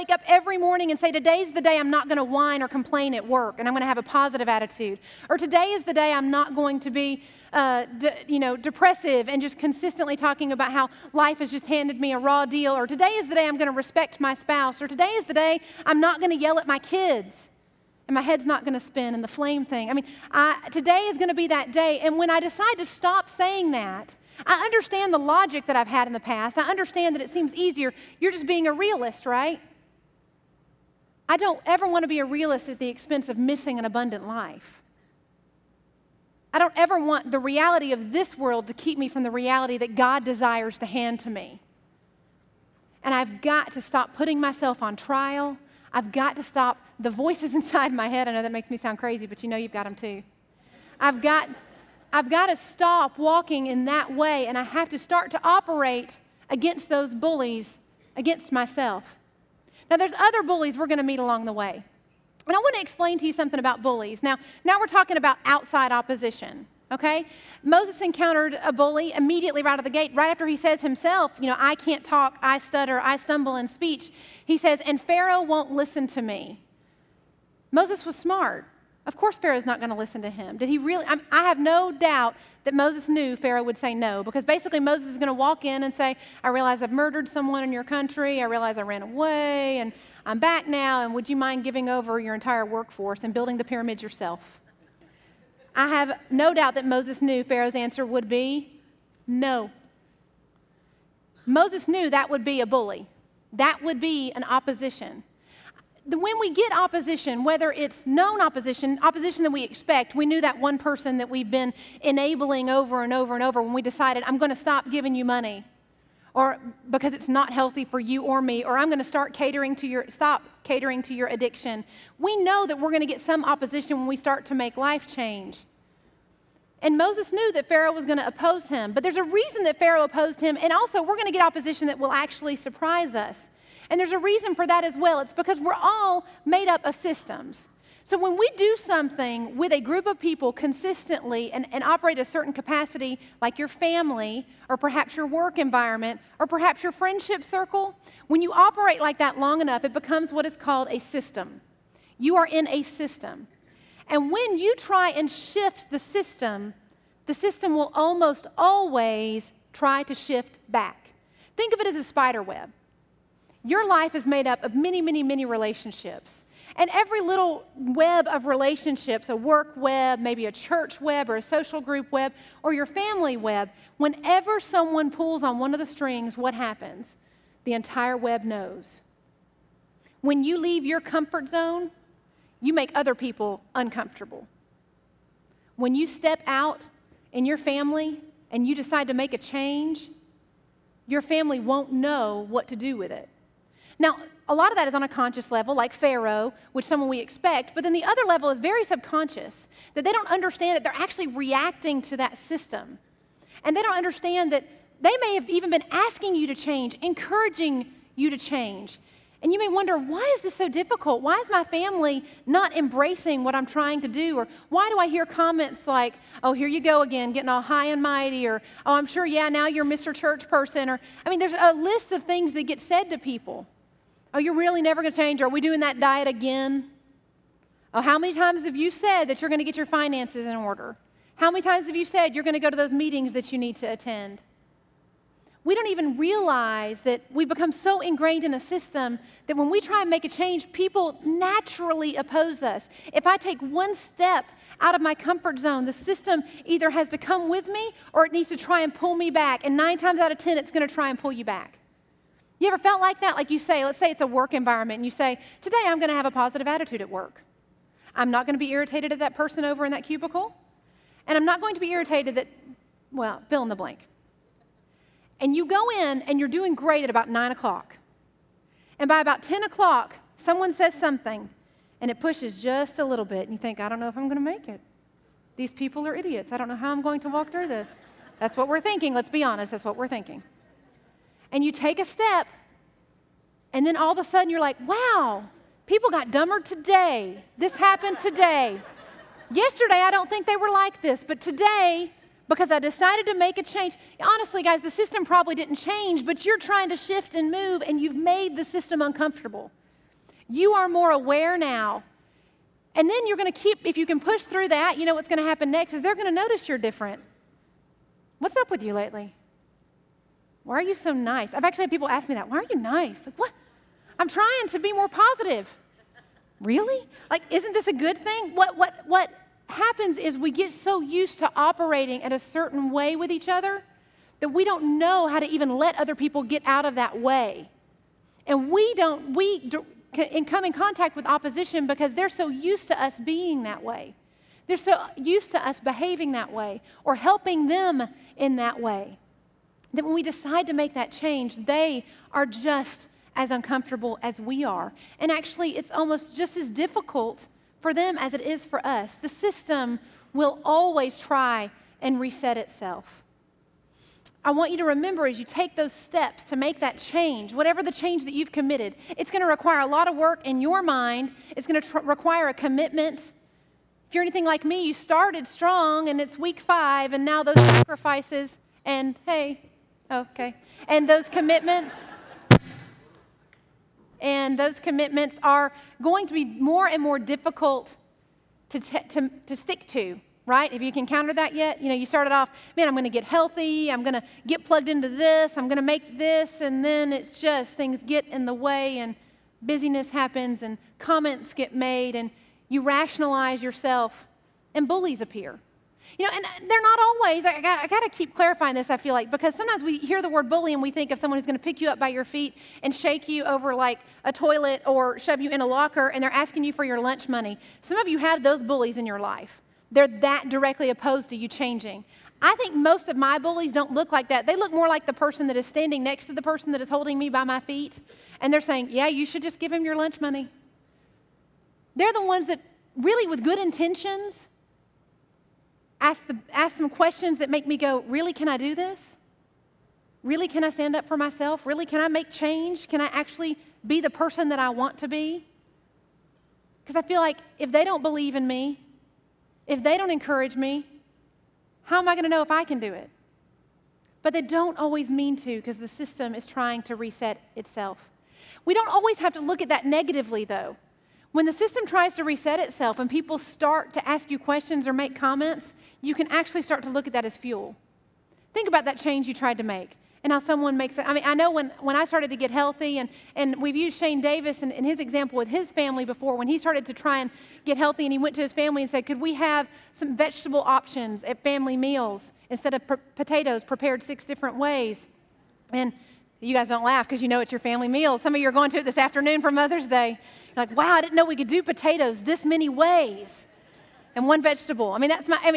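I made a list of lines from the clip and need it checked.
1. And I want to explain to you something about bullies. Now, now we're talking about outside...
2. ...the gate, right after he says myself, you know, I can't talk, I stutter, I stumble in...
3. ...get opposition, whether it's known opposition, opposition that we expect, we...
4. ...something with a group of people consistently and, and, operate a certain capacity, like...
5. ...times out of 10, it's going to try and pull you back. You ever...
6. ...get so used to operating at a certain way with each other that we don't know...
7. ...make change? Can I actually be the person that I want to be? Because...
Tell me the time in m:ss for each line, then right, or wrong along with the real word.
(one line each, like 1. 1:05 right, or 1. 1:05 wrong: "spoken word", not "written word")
1. 1:02 right
2. 1:09 wrong: "himself", not "myself"
3. 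1:46 right
4. 2:18 right
5. 4:09 right
6. 5:20 right
7. 7:12 right.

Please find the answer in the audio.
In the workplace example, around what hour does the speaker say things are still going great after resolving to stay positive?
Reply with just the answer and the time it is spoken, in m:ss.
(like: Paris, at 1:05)
9 o'clock, at 4:27.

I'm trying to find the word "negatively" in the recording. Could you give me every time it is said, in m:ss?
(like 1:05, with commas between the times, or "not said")
7:29.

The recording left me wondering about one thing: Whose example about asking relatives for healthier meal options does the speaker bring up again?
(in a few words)
Shane Davis.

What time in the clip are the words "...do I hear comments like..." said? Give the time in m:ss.
3:34.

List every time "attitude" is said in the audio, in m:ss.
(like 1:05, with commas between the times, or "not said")
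0:04, 4:16.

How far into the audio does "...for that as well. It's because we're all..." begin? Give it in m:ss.
2:14.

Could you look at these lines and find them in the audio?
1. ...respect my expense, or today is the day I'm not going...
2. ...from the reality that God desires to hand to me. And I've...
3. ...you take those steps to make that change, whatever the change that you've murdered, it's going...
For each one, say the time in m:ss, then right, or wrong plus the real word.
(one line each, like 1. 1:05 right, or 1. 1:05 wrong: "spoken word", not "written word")
1. 0:13 wrong: "spouse", not "expense"
2. 0:39 right
3. 5:55 wrong: "committed", not "murdered".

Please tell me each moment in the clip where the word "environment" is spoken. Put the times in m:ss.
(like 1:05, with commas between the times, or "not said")
2:25, 4:14.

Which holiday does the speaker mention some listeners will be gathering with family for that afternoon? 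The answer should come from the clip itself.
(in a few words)
Mother's Day.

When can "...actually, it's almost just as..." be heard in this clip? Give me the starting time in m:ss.
5:45.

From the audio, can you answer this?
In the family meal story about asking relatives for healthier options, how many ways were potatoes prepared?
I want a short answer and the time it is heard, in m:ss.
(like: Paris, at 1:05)
6, at 7:54.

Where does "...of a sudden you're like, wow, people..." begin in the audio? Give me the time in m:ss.
4:44.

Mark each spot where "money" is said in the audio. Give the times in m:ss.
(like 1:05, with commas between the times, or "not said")
1:55, 6:47, 7:00.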